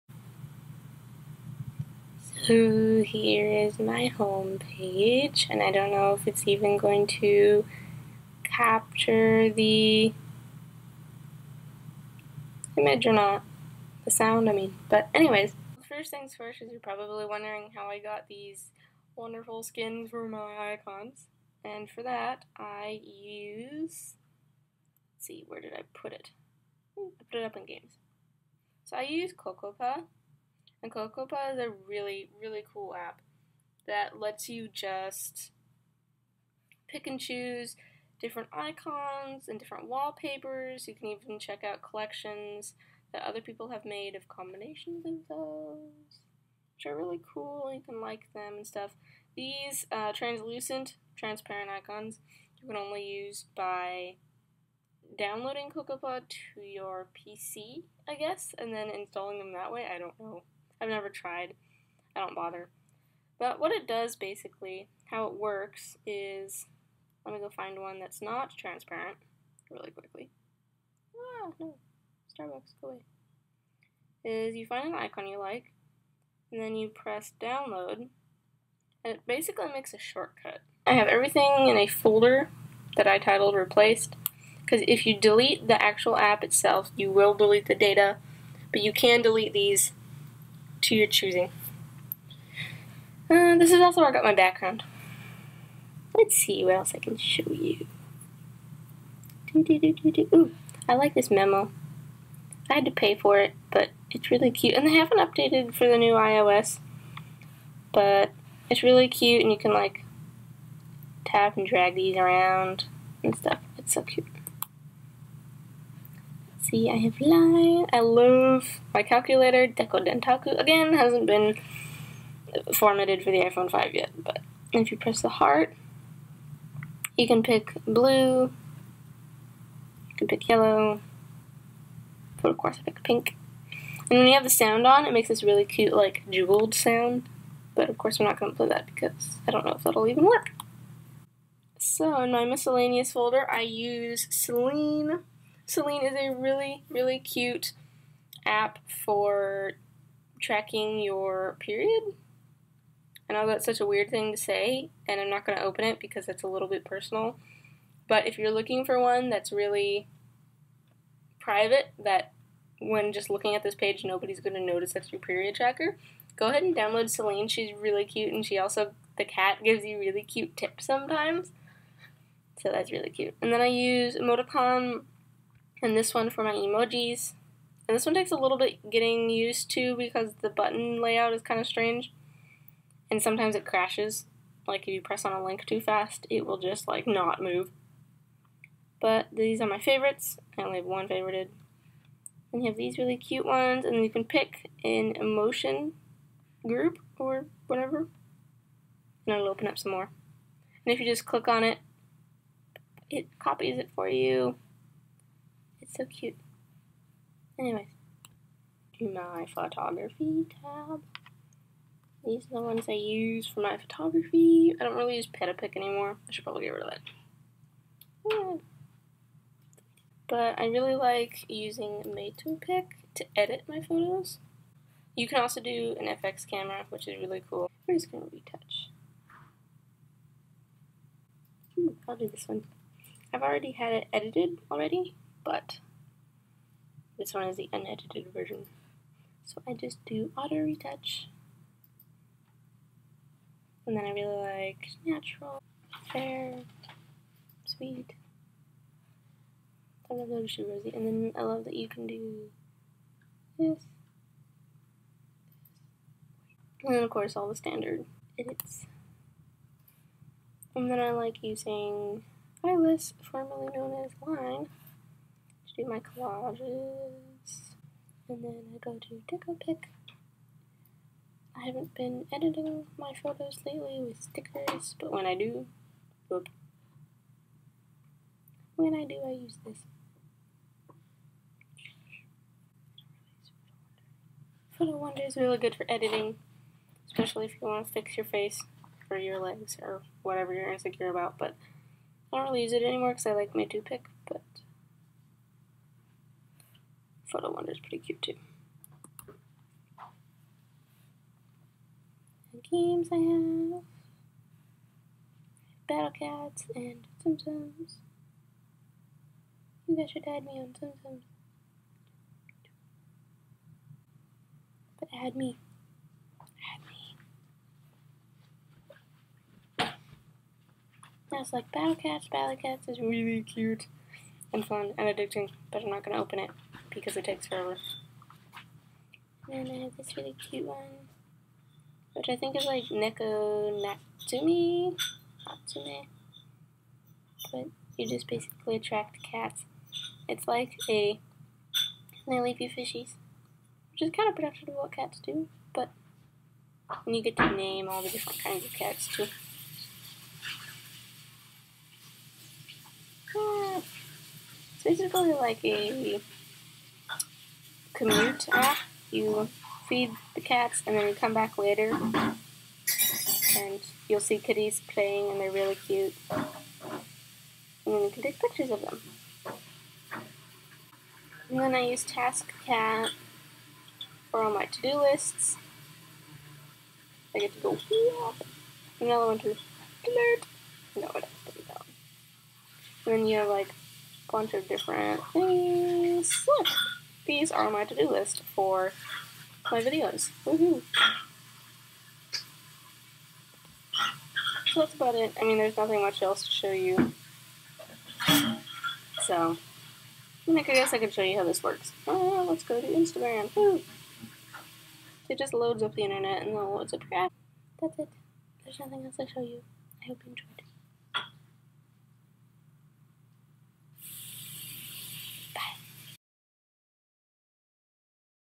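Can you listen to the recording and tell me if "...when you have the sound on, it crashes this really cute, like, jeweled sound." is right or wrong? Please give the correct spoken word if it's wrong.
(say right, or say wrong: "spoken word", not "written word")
wrong: "makes", not "crashes".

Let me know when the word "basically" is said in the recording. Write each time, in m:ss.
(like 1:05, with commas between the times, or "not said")
1:04, 1:19, 5:38, 5:54.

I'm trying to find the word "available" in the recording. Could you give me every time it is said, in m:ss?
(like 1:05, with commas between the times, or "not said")
not said.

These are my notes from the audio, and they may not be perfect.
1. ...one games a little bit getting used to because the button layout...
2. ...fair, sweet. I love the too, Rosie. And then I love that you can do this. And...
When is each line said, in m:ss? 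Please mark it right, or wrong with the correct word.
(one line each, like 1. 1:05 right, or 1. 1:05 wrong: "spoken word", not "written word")
1. 2:58 wrong: "takes", not "games"
2. 4:06 right.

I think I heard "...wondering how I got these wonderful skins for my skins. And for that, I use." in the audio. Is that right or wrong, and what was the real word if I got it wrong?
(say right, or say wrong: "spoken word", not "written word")
wrong: "icons", not "skins".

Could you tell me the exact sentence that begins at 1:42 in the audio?
I had to pay for it, but it's really cute.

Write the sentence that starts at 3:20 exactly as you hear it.
And if you just click on it, it copies it for you.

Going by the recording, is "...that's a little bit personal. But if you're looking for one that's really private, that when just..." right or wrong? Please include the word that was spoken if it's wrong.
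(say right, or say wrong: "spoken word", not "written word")
right.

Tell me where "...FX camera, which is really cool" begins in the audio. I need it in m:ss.
3:46.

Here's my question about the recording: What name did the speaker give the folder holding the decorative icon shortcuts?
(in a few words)
replaced.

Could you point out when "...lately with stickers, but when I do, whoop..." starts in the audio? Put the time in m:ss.
4:33.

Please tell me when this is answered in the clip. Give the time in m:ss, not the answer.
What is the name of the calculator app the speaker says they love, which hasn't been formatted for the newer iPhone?
1:59.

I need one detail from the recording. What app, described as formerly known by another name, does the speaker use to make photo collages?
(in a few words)
Eyeless.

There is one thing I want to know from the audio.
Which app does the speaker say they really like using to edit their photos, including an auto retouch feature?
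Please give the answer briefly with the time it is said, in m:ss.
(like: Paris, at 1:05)
Matopic, at 3:42.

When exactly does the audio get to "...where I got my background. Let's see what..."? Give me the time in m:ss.
1:34.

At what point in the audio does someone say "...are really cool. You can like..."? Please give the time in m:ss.
0:46.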